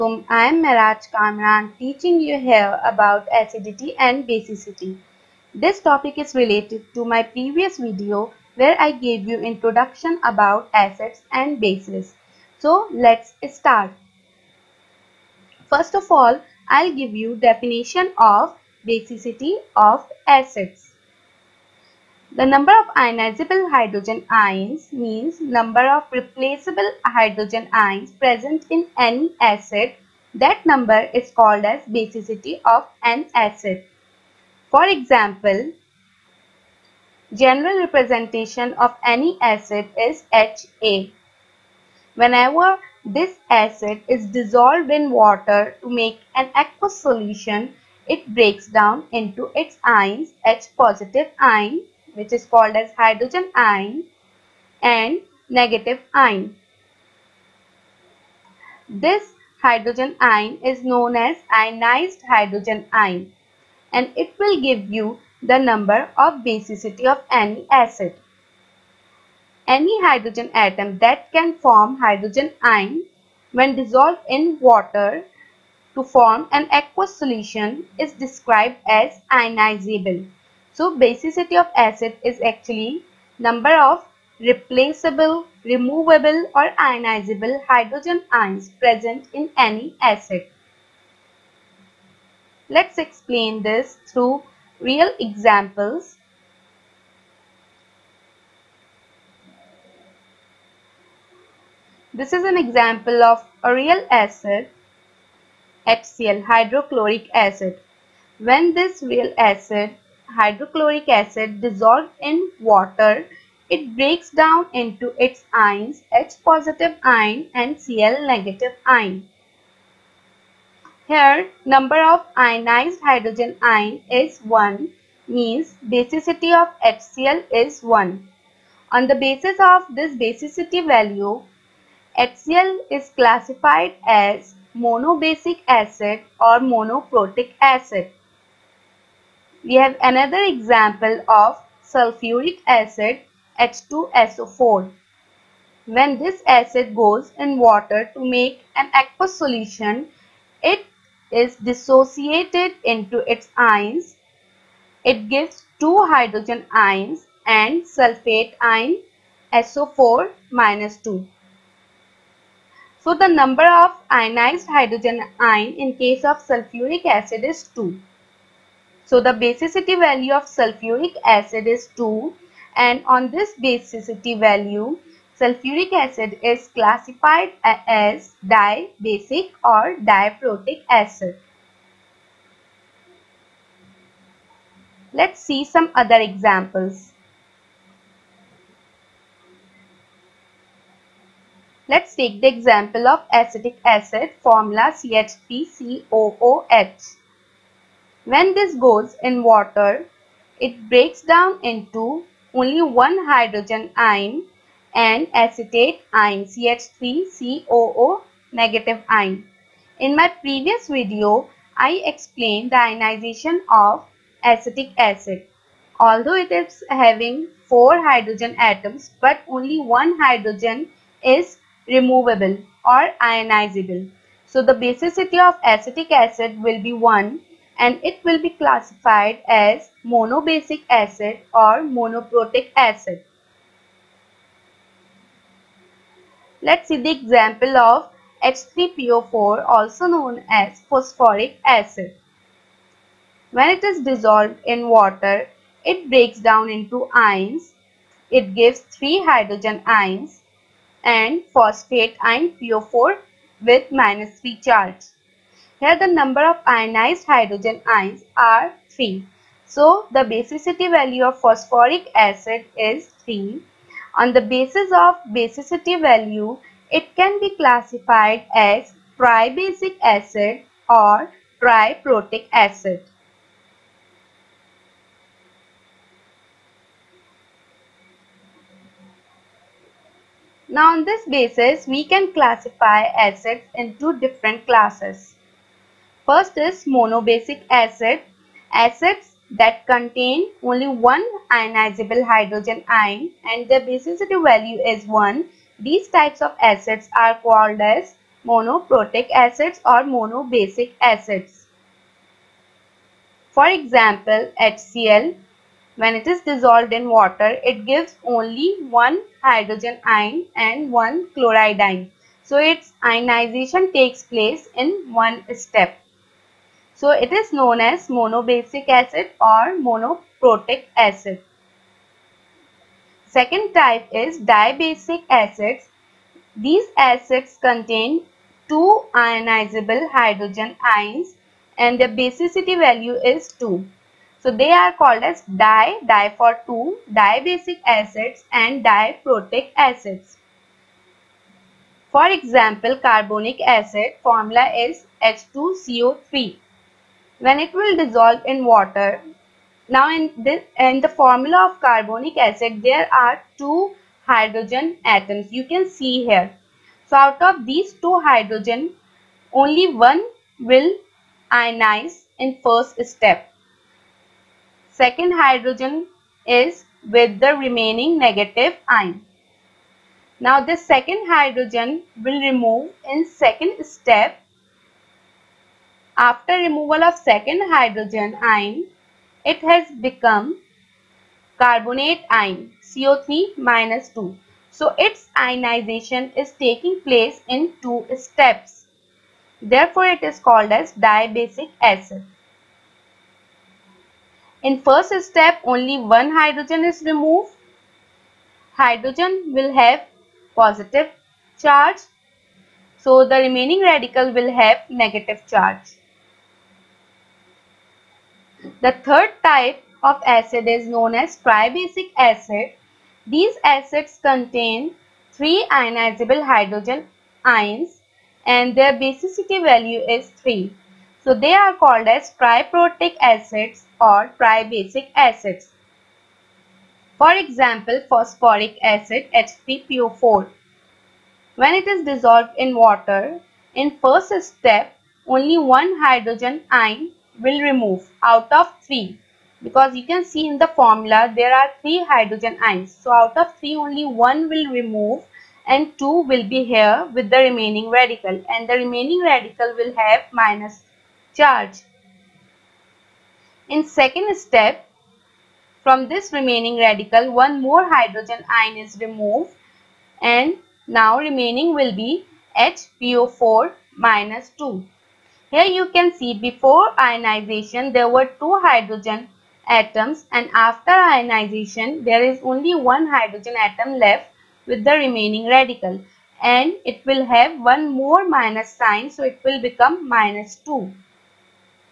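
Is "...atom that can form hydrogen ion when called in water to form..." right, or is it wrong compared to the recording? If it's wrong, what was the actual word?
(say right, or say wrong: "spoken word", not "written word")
wrong: "dissolved", not "called".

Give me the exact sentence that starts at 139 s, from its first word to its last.
We have another example of sulfuric acid H2SO4.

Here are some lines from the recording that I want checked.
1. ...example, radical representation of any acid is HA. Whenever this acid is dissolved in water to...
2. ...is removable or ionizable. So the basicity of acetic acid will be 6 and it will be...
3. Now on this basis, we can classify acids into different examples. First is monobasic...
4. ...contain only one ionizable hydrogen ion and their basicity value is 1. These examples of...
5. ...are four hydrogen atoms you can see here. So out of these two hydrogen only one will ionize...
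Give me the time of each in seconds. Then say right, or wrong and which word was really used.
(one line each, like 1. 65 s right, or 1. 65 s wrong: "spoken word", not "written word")
1. 34 s wrong: "general", not "radical"
2. 221 s wrong: "1", not "6"
3. 280 s wrong: "classes", not "examples"
4. 289 s wrong: "types", not "examples"
5. 353 s wrong: "two", not "four".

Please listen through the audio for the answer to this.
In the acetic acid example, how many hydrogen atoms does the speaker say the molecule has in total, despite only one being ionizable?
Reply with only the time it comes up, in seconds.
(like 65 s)
217 s.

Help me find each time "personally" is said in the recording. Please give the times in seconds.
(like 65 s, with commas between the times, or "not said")
not said.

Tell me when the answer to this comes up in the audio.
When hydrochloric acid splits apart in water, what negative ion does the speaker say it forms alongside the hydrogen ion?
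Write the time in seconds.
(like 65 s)
117 s.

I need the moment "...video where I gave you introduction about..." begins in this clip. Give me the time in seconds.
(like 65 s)
7 s.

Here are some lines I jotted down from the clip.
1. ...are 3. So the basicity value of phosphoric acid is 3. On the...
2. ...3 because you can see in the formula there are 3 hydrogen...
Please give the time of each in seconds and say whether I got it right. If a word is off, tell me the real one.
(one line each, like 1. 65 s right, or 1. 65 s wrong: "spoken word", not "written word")
1. 258 s right
2. 438 s right.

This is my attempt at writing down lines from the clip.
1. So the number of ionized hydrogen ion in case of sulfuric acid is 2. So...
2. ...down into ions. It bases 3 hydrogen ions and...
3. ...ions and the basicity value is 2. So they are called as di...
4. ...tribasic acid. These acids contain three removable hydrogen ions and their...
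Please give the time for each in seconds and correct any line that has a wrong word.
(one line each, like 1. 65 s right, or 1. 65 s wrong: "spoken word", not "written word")
1. 163 s right
2. 246 s wrong: "gives", not "bases"
3. 330 s right
4. 411 s wrong: "ionizable", not "removable".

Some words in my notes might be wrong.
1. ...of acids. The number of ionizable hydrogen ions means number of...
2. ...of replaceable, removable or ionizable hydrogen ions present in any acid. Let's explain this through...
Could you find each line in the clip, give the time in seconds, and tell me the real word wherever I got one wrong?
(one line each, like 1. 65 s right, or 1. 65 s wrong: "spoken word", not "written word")
1. 19 s right
2. 83 s right.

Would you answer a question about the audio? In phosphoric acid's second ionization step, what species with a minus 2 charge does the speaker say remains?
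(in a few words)
HPO4 2-.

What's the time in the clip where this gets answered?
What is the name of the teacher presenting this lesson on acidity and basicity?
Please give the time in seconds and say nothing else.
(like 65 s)
0 s.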